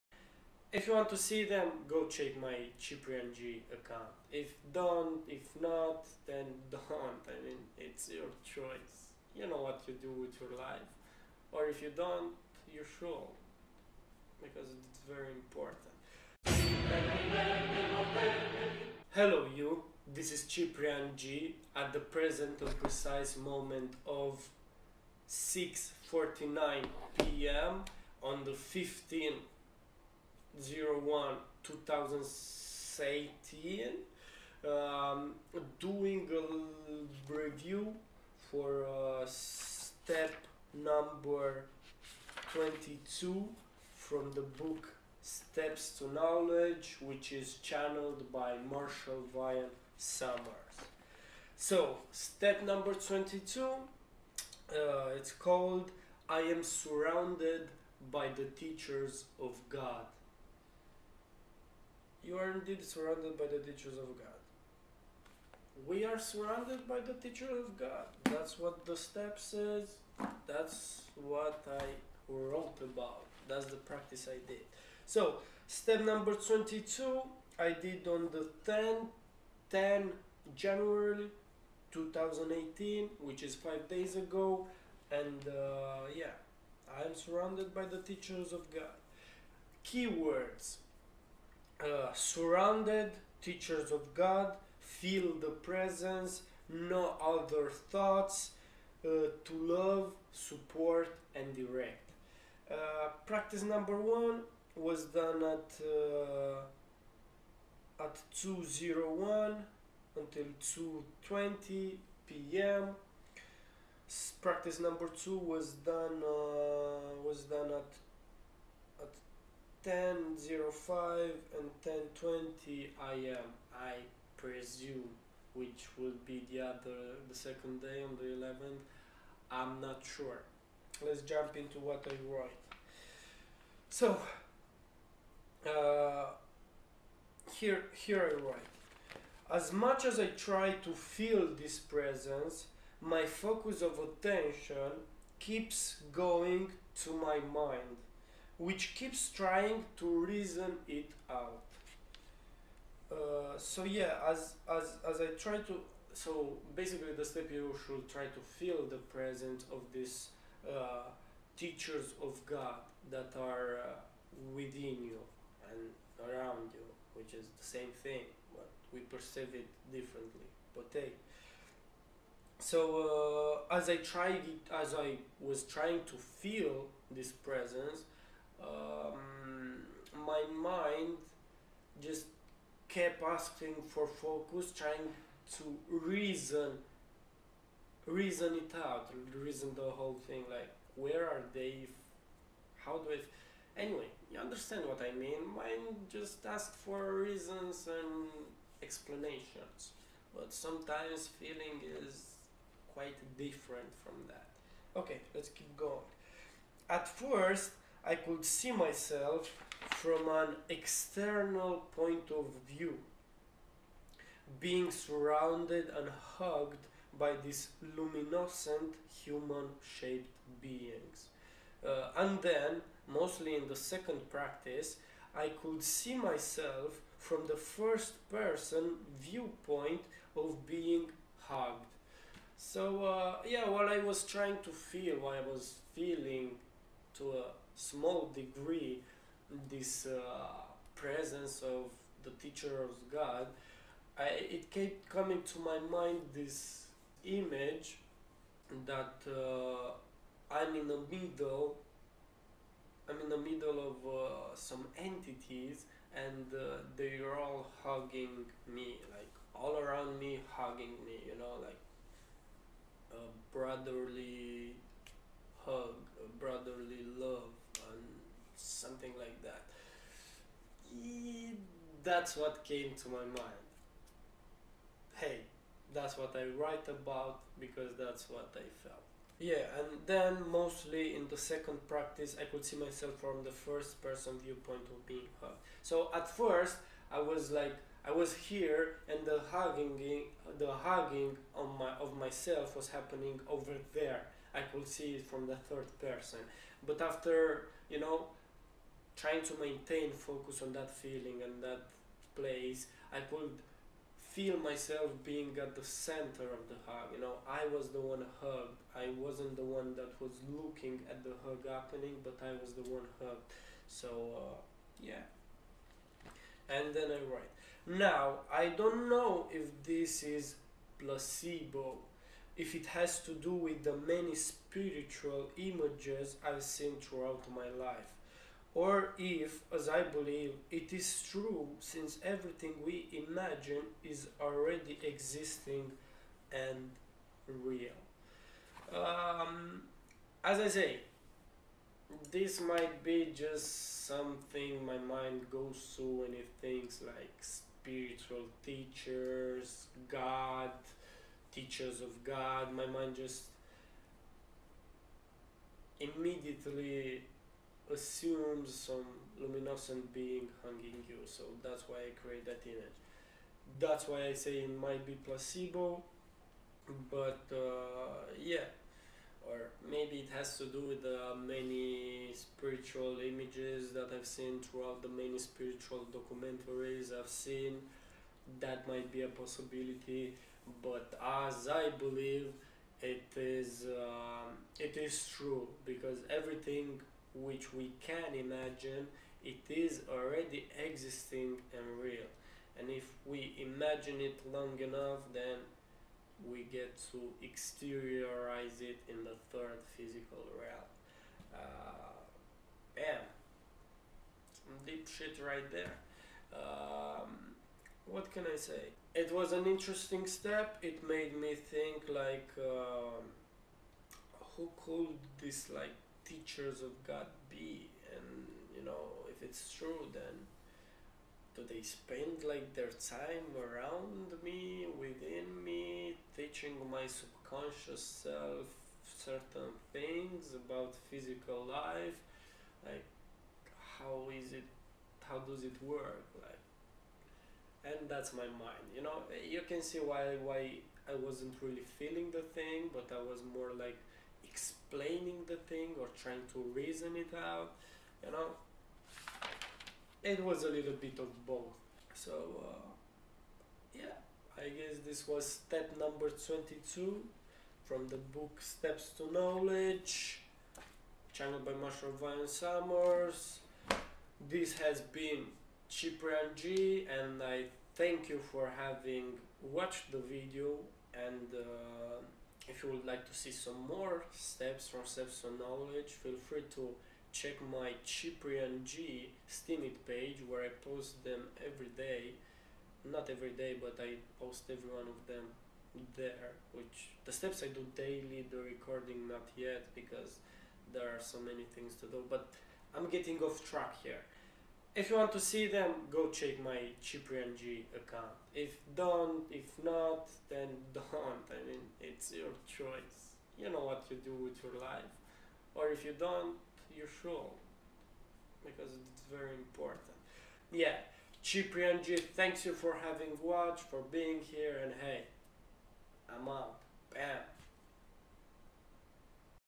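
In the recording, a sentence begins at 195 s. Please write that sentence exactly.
Mind just asked for reasons and explanations, but sometimes feeling is quite different from that.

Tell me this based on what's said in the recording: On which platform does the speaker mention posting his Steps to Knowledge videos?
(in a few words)
Steam.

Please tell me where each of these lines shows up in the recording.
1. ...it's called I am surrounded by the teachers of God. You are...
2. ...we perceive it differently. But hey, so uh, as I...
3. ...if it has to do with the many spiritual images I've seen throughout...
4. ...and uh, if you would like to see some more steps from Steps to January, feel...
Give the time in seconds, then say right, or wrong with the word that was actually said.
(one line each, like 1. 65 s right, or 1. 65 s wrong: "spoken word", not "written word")
1. 55 s right
2. 168 s right
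3. 322 s right
4. 471 s wrong: "Knowledge", not "January".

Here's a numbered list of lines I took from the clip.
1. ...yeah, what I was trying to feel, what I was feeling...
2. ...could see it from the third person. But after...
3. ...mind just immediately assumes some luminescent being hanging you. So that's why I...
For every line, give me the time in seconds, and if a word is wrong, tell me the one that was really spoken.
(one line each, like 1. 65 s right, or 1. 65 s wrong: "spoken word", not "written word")
1. 233 s right
2. 294 s right
3. 352 s right.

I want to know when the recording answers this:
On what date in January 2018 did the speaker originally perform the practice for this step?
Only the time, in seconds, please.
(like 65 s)
79 s.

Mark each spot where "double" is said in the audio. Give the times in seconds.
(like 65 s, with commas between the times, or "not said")
not said.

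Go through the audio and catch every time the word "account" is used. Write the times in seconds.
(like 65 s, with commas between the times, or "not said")
3 s, 497 s.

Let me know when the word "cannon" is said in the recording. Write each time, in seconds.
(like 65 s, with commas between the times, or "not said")
not said.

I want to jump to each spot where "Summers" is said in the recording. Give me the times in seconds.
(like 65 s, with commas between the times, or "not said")
49 s, 462 s.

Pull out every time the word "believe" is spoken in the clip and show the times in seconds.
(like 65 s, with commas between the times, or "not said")
330 s, 381 s.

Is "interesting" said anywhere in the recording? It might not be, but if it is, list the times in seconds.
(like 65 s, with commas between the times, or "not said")
409 s.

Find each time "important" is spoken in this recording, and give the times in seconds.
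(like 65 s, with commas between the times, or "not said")
15 s, 509 s.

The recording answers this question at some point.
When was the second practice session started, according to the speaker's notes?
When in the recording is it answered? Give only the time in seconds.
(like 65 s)
119 s.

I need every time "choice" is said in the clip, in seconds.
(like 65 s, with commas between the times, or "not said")
8 s, 502 s.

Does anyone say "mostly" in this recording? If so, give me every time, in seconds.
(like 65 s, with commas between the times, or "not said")
223 s, 280 s.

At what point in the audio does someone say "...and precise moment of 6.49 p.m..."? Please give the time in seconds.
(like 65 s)
22 s.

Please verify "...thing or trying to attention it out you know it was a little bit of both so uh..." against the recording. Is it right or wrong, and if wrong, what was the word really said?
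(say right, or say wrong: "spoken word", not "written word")
wrong: "reason", not "attention".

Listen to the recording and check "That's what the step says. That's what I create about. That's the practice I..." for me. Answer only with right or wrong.
wrong.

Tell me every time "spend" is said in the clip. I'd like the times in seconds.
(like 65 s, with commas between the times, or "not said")
421 s.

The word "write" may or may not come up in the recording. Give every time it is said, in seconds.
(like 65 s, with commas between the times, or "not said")
132 s, 138 s, 276 s, 317 s.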